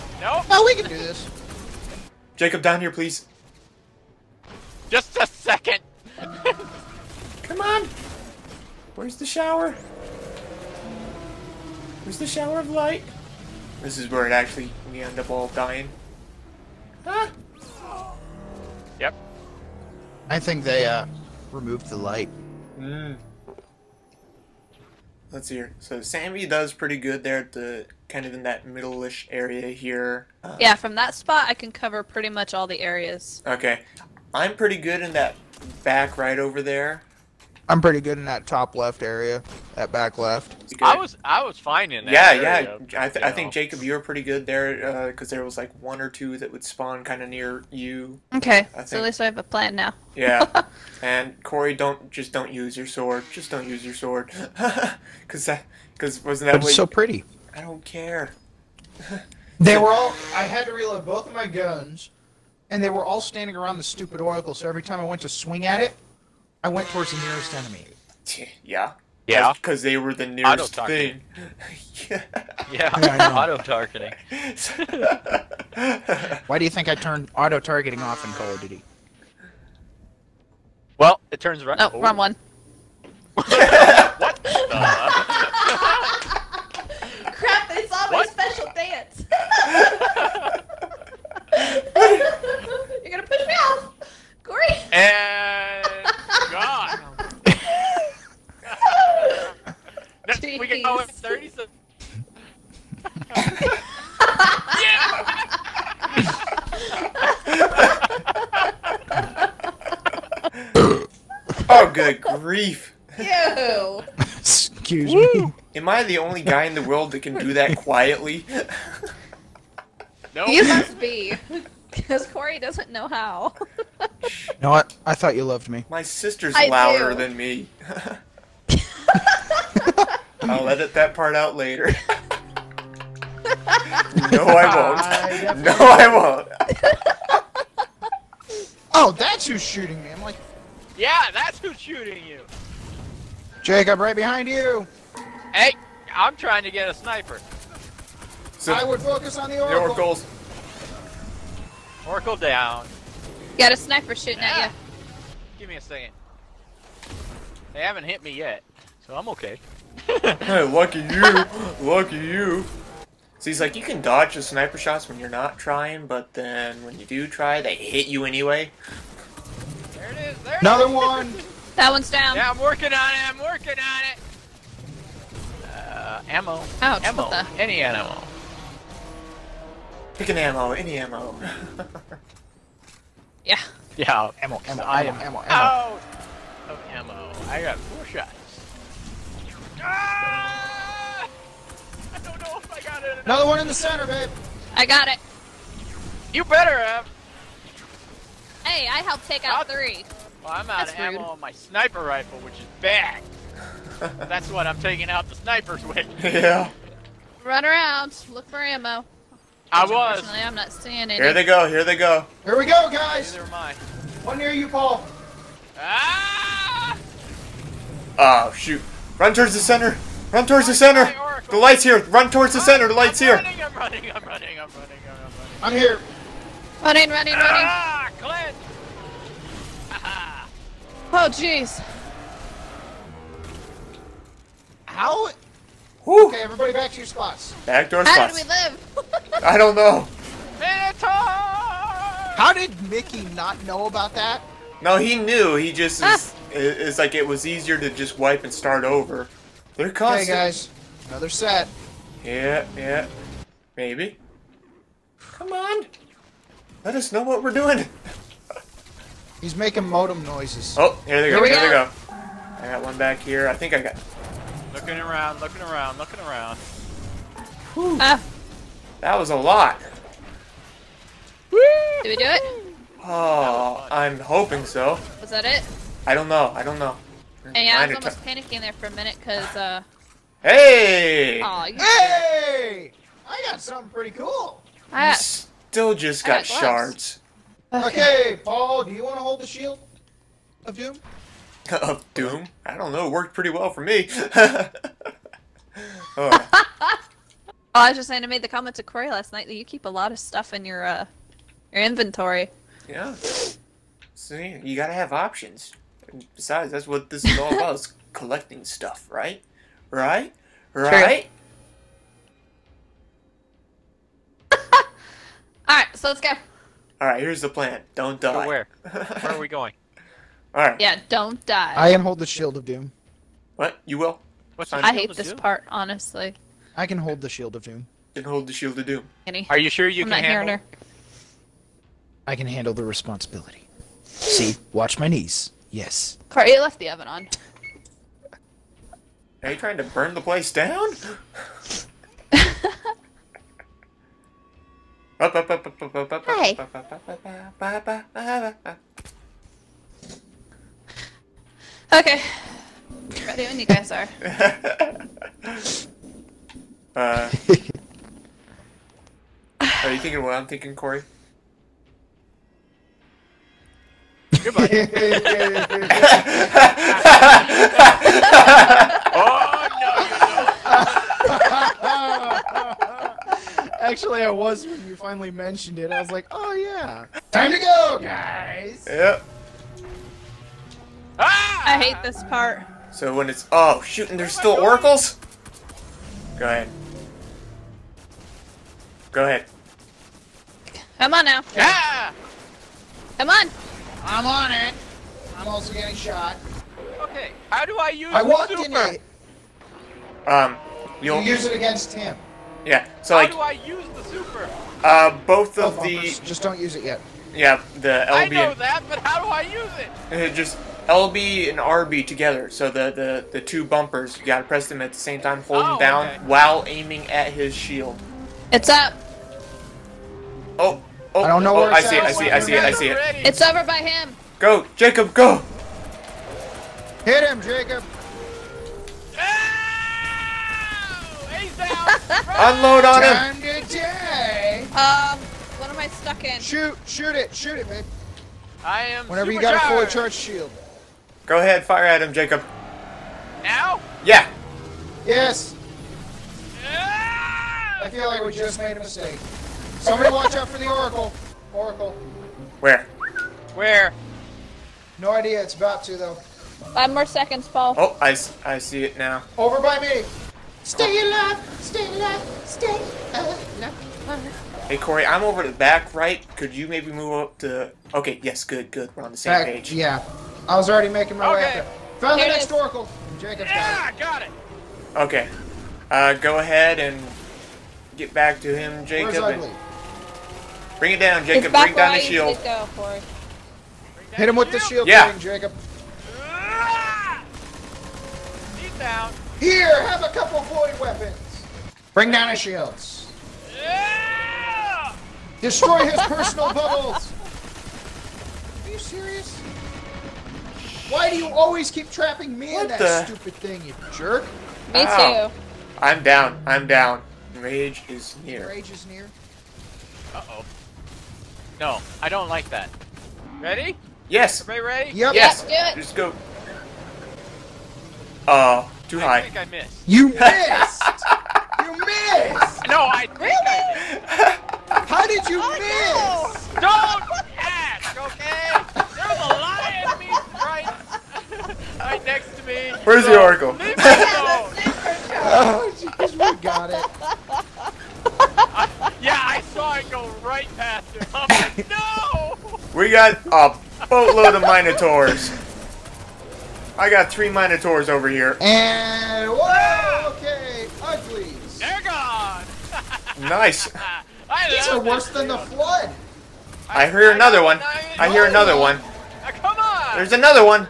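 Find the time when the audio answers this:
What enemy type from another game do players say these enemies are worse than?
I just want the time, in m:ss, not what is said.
9:15.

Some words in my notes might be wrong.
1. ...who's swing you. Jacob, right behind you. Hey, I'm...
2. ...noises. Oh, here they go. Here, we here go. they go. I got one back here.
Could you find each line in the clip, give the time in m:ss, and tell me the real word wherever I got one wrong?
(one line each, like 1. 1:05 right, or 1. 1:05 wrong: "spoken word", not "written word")
1. 2:21 wrong: "shooting", not "swing"
2. 4:20 right.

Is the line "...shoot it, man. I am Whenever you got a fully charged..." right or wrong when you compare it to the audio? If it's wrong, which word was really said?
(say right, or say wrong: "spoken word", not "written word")
right.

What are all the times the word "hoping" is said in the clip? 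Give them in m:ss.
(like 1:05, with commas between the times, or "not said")
4:34.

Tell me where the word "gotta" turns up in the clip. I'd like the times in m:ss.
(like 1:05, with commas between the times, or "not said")
5:04, 6:54.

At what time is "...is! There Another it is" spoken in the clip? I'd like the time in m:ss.
2:50.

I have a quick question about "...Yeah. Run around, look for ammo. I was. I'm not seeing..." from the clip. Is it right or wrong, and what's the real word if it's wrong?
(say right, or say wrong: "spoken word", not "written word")
right.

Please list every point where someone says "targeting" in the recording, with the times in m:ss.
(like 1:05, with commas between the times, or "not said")
1:13, 1:17.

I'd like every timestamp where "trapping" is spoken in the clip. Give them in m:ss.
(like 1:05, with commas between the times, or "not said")
8:21.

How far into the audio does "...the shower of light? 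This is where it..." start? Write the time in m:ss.
0:12.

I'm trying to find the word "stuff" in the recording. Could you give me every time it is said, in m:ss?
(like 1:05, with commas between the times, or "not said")
5:00, 5:08.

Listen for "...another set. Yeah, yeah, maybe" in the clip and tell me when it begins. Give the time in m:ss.
4:11.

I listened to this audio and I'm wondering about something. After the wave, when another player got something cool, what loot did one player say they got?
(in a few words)
shards.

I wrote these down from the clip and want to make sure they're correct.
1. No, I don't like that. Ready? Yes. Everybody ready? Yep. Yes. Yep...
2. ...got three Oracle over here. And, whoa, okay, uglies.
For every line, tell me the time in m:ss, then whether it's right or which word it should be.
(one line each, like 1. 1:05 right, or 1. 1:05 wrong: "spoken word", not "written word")
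1. 8:31 right
2. 9:06 wrong: "Minotaurs", not "Oracle".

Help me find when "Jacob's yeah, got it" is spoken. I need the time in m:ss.
7:53.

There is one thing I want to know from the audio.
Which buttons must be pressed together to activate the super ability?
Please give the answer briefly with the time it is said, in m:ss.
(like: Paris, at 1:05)
LB and RB, at 6:50.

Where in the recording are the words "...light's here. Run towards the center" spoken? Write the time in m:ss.
3:41.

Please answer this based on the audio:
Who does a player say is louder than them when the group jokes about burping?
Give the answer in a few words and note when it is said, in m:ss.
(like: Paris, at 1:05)
My sister, at 2:05.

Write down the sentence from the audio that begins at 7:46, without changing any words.
Could you maybe move up to...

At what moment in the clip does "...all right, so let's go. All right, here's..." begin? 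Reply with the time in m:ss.
5:14.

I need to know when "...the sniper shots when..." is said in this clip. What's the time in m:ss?
2:44.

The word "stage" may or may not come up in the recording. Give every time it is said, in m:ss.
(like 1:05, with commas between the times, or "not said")
not said.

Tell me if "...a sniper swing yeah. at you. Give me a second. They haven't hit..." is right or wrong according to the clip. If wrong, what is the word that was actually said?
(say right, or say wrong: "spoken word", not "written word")
wrong: "shooting", not "swing".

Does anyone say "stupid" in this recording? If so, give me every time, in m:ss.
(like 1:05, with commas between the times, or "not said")
1:03, 8:23.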